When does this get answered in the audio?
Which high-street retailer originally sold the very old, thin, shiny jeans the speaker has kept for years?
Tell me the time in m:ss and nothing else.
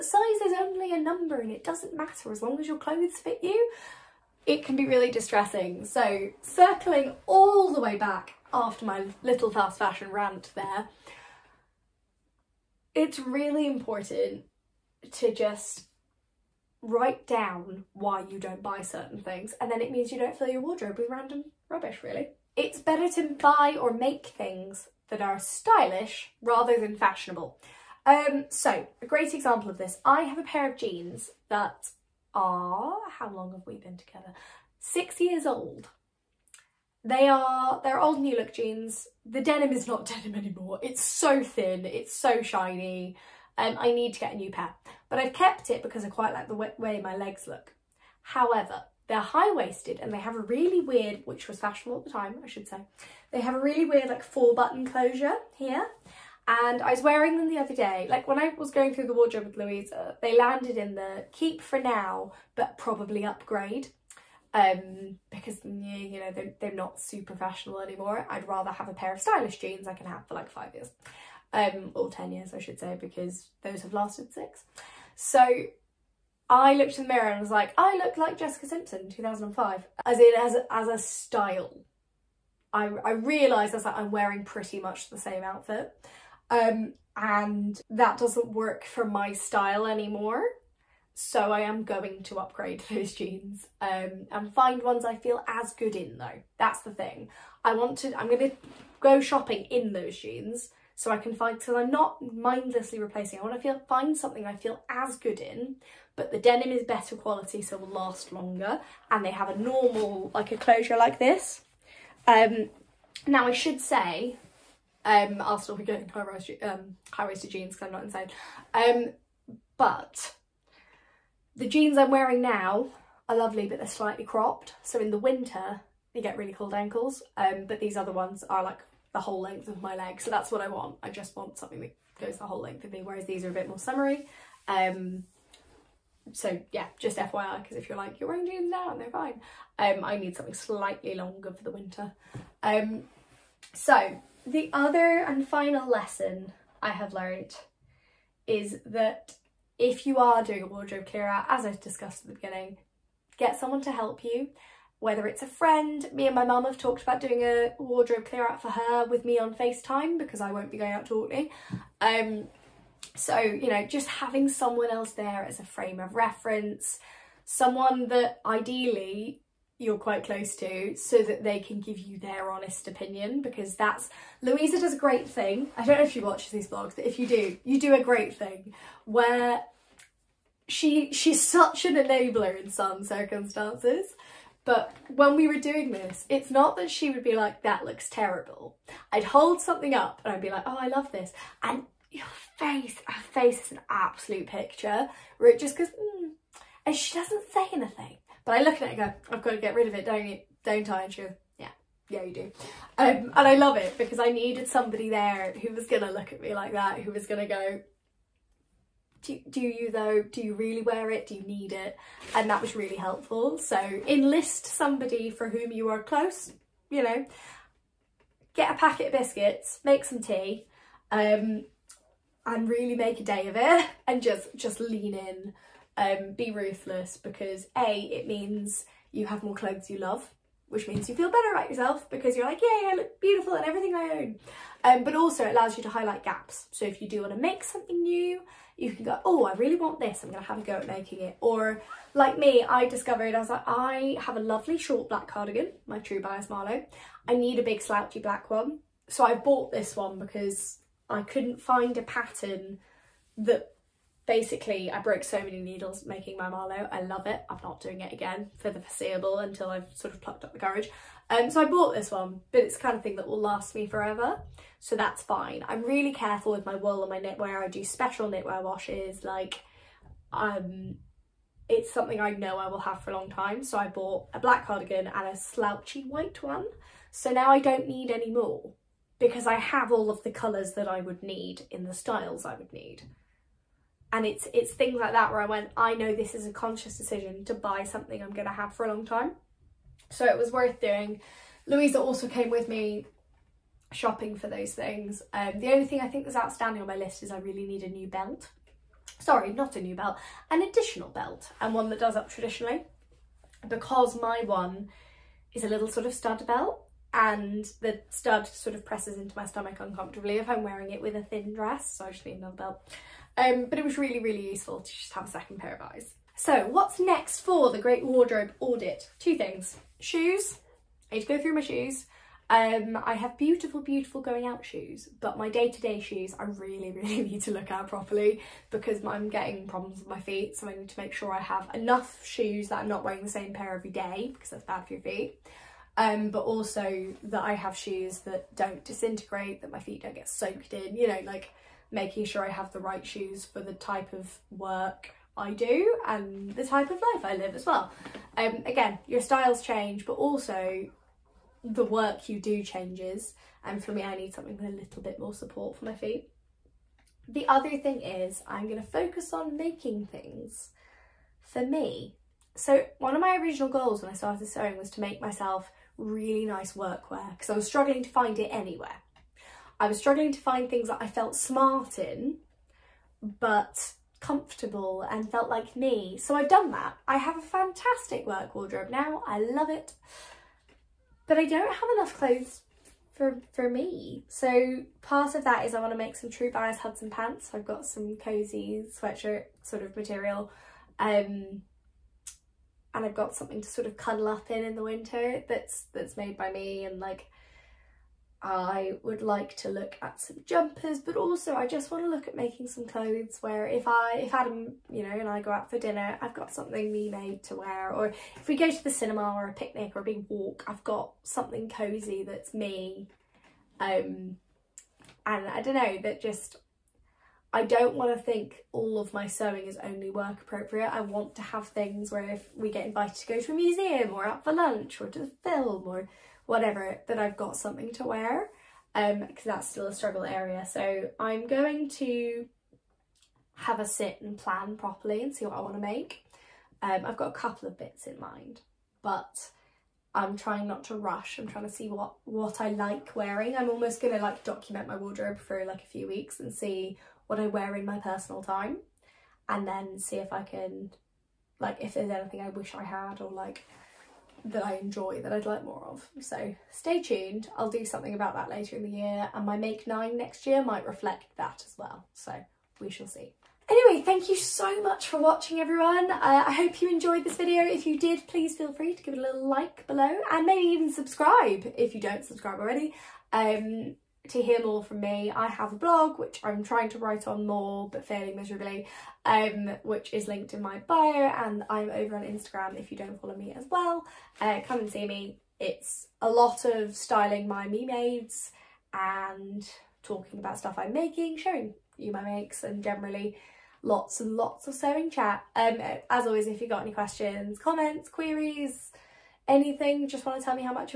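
0:38.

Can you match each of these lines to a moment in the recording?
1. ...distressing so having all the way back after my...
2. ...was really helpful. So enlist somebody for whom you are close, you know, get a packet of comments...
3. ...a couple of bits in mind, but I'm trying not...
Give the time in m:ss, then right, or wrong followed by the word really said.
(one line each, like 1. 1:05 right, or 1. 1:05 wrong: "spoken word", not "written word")
1. 0:05 wrong: "circling", not "having"
2. 3:32 wrong: "biscuits", not "comments"
3. 7:17 right.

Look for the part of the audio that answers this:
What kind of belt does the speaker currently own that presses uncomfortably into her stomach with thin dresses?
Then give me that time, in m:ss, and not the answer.
5:06.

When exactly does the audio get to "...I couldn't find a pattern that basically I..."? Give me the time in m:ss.
4:11.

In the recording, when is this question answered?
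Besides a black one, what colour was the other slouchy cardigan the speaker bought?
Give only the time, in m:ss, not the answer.
4:36.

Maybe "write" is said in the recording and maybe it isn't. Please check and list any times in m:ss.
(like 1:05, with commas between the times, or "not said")
0:16, 7:56.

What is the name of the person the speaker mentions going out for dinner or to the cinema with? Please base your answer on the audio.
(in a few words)
Adam.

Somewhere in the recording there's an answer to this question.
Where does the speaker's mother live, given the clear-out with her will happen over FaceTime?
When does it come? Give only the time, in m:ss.
2:41.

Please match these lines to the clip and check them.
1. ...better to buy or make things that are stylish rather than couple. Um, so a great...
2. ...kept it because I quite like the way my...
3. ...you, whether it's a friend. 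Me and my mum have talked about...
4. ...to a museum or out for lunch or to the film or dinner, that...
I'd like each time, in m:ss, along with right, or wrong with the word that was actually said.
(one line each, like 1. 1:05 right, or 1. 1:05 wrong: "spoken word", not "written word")
1. 0:22 wrong: "fashionable", not "couple"
2. 0:45 right
3. 2:34 right
4. 7:03 wrong: "whatever", not "dinner".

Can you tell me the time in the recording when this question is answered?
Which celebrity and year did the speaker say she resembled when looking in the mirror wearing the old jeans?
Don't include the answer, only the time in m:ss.
1:18.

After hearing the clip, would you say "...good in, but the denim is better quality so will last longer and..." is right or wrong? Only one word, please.
right.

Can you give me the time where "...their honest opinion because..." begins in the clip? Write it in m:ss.
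2:52.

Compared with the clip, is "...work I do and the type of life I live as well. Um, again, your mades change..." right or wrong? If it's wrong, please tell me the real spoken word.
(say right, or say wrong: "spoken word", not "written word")
wrong: "styles", not "mades".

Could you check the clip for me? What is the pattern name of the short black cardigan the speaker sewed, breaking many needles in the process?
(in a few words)
True Bias Marlowe.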